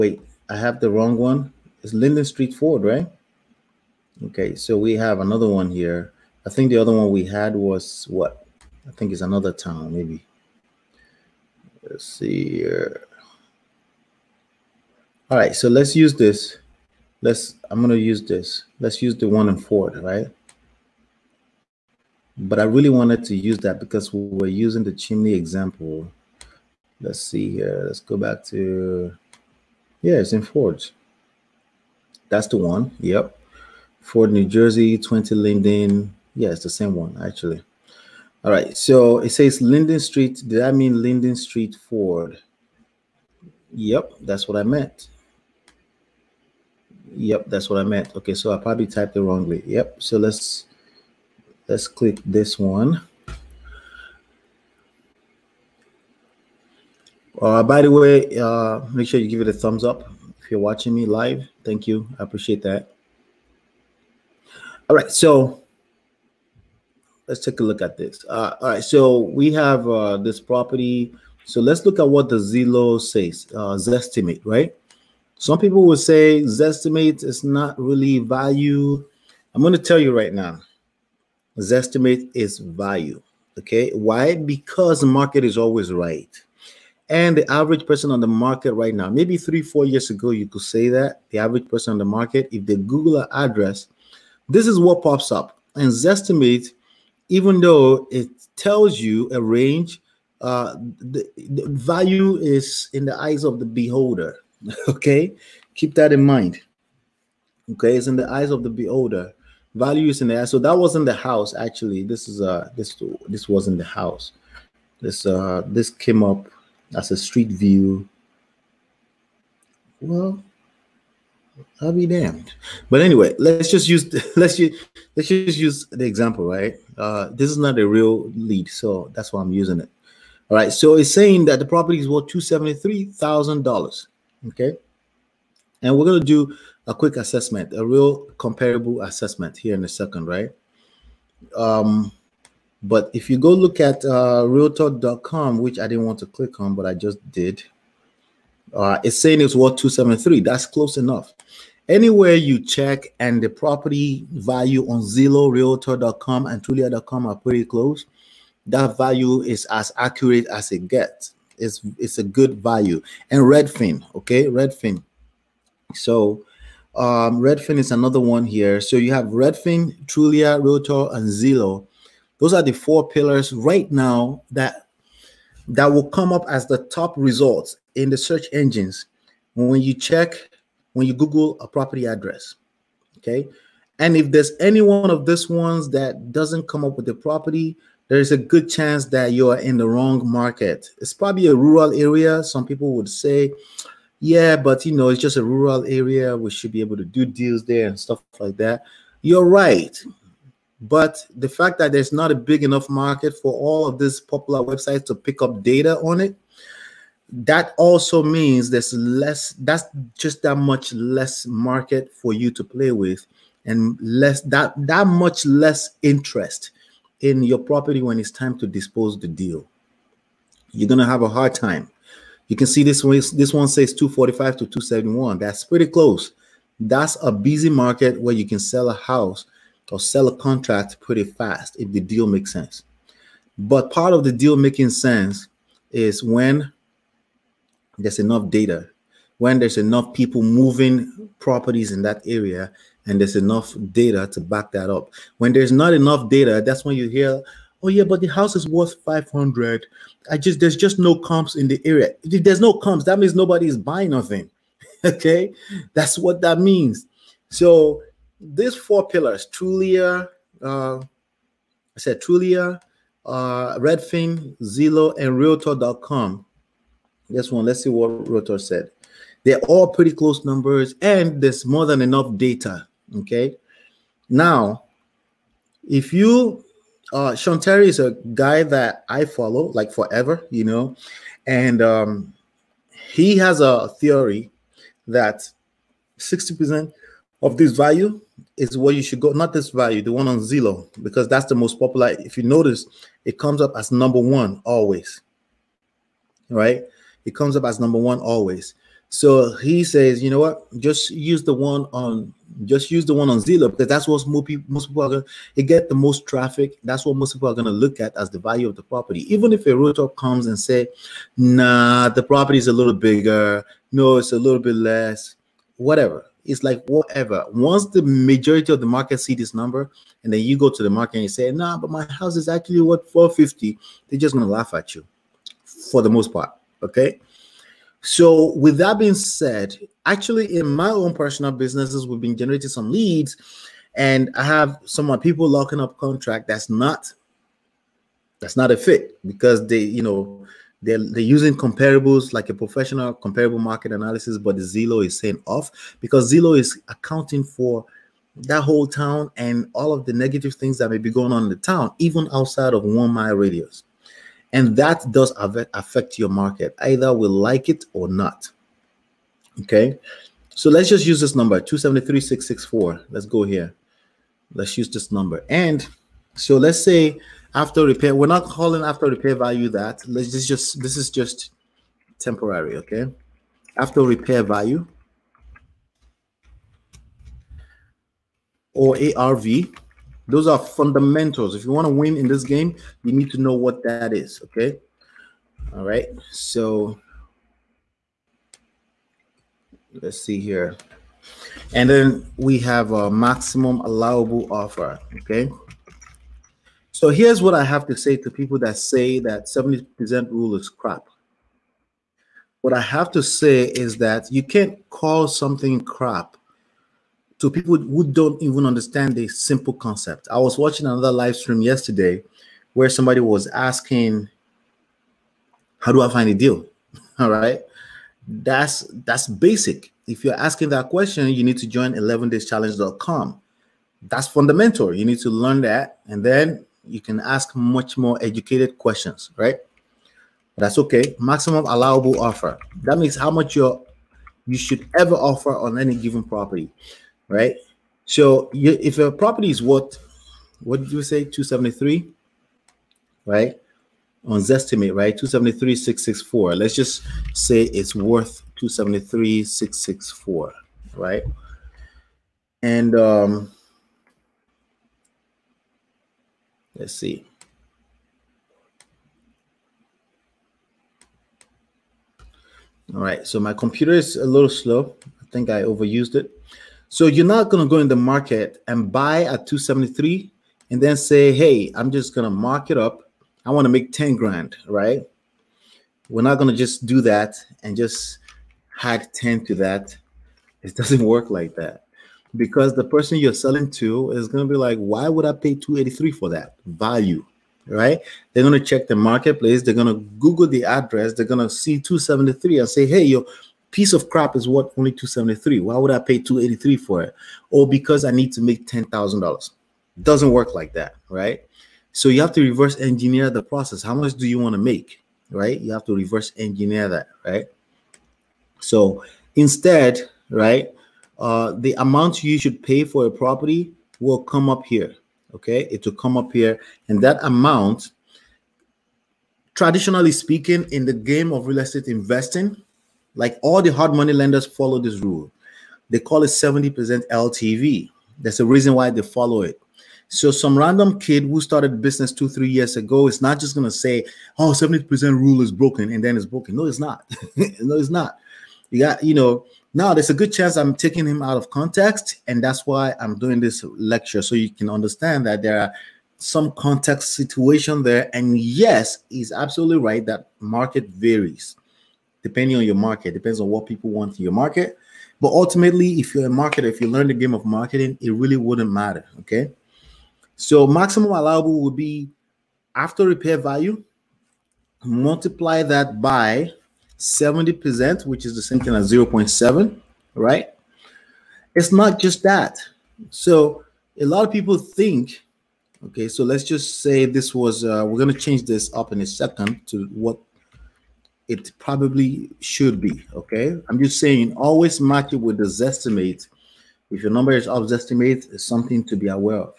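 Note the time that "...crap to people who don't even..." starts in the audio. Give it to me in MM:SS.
06:45.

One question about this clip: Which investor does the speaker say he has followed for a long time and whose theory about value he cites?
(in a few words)
Sean Terry.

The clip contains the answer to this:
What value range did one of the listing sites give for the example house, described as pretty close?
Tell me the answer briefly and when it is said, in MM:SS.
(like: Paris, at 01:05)
245 to 271, at 03:43.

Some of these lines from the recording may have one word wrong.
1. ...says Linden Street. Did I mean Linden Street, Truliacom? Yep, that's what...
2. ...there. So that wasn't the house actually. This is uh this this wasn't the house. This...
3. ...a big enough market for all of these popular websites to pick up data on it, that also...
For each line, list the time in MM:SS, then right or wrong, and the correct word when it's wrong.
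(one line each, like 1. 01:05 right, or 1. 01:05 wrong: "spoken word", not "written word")
1. 00:39 wrong: "Ford", not "Truliacom"
2. 01:50 right
3. 03:22 right.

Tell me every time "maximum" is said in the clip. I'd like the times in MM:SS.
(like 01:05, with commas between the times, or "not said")
06:33, 07:11, 09:20.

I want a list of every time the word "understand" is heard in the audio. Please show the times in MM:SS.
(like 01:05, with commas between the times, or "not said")
06:48, 09:04.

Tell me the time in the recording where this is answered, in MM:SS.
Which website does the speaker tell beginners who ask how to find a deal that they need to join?
07:01.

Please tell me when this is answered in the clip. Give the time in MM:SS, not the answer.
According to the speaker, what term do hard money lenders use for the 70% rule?
08:46.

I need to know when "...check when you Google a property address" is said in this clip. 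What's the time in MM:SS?
02:59.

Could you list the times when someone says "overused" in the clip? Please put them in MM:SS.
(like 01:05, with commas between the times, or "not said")
07:45.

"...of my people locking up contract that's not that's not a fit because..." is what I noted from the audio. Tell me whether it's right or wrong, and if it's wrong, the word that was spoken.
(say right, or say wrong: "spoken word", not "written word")
right.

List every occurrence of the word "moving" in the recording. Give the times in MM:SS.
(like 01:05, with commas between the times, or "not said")
04:00.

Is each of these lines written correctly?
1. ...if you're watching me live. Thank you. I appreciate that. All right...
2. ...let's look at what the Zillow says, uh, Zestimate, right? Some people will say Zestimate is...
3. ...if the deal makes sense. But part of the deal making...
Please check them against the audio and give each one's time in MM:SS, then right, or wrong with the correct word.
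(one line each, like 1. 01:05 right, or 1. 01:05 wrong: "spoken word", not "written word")
1. 01:00 right
2. 01:11 right
3. 03:51 right.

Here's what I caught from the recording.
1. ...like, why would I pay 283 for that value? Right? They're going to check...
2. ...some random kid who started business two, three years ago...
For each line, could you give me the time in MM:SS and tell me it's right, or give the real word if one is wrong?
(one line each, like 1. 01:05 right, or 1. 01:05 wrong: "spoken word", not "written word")
1. 08:04 right
2. 08:50 right.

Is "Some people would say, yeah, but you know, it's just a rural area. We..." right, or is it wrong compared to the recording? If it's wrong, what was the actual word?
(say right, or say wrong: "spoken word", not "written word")
right.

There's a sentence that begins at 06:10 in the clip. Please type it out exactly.
Let's just, just this is just temporary, okay?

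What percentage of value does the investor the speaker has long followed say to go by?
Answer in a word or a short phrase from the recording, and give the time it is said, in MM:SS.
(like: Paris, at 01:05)
60%, at 04:46.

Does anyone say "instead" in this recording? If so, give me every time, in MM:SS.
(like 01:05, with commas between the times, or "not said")
08:29.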